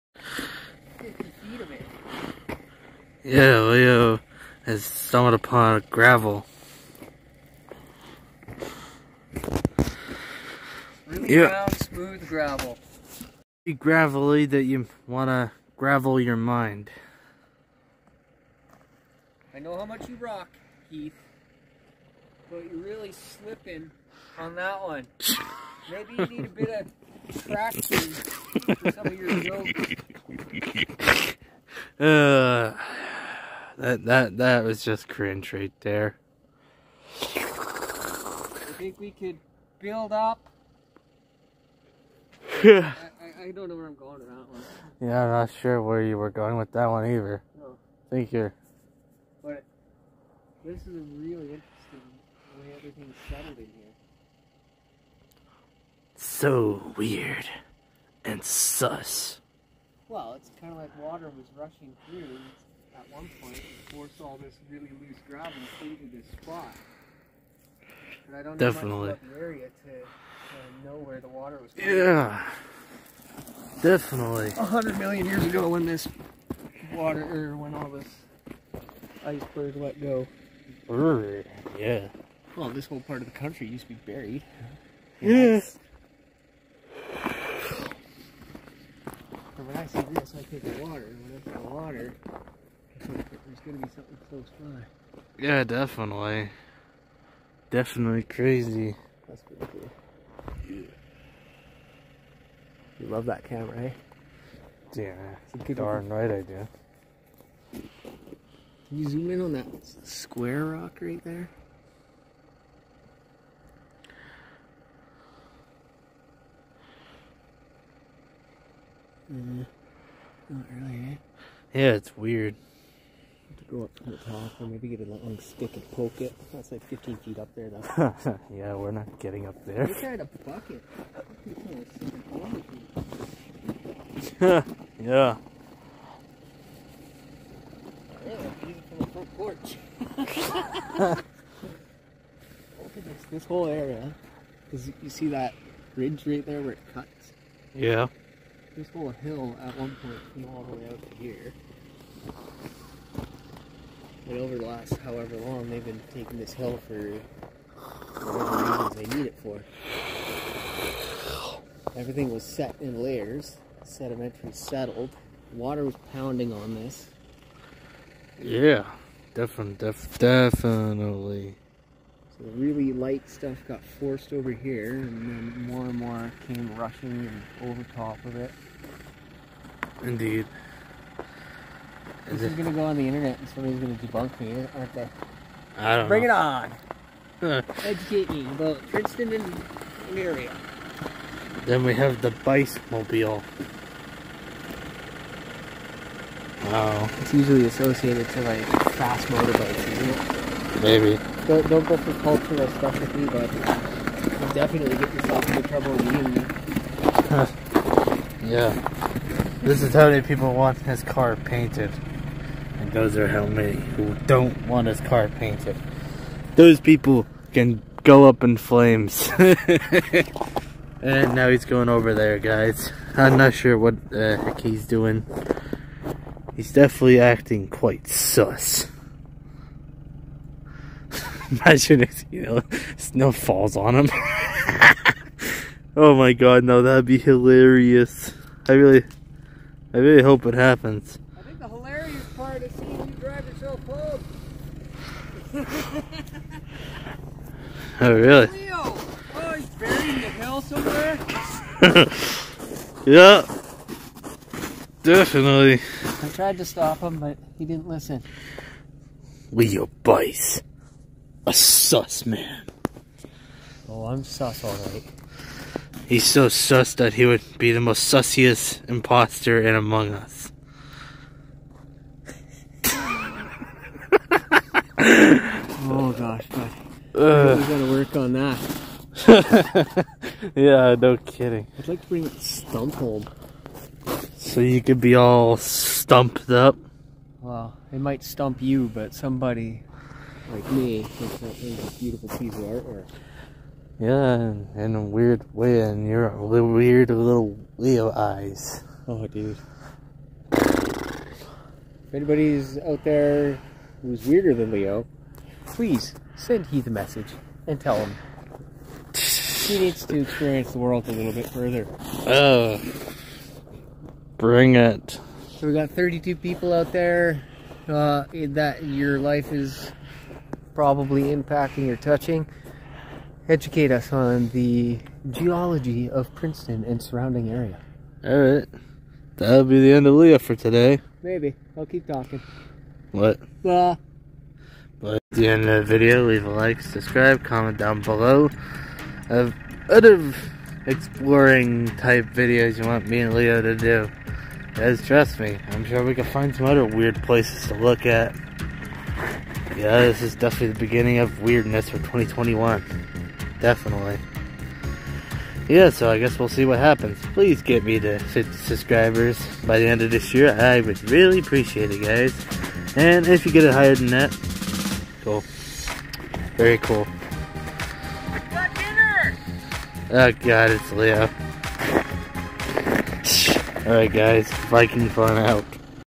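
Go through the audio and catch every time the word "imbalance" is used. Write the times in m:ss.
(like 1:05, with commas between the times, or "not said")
not said.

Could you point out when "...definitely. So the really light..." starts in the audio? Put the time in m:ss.
2:50.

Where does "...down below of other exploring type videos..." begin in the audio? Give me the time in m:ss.
5:37.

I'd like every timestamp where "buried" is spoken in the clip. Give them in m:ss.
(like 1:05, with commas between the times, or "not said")
1:24, 4:09.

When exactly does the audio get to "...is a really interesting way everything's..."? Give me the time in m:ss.
0:50.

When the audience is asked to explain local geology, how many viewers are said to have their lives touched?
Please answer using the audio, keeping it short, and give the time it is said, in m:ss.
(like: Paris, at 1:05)
32, at 5:15.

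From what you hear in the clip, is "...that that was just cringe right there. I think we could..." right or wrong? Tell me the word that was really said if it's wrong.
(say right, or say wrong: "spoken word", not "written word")
right.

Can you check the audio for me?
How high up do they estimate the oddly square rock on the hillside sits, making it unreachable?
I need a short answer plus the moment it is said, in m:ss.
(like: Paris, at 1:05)
15 feet, at 2:06.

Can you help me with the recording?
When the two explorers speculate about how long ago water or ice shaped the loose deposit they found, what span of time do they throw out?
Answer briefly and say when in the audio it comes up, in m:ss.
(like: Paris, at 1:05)
A hundred million years, at 1:14.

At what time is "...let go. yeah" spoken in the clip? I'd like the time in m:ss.
1:19.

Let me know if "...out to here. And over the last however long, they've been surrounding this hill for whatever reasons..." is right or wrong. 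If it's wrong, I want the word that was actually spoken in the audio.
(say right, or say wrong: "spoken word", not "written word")
wrong: "taking", not "surrounding".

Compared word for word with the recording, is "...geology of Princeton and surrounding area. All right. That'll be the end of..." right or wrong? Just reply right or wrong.
right.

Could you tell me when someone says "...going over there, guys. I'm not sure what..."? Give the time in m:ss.
3:41.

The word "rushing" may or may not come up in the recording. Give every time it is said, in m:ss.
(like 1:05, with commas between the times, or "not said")
1:01, 2:56.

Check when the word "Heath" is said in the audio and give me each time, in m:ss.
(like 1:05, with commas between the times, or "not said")
0:20, 5:06.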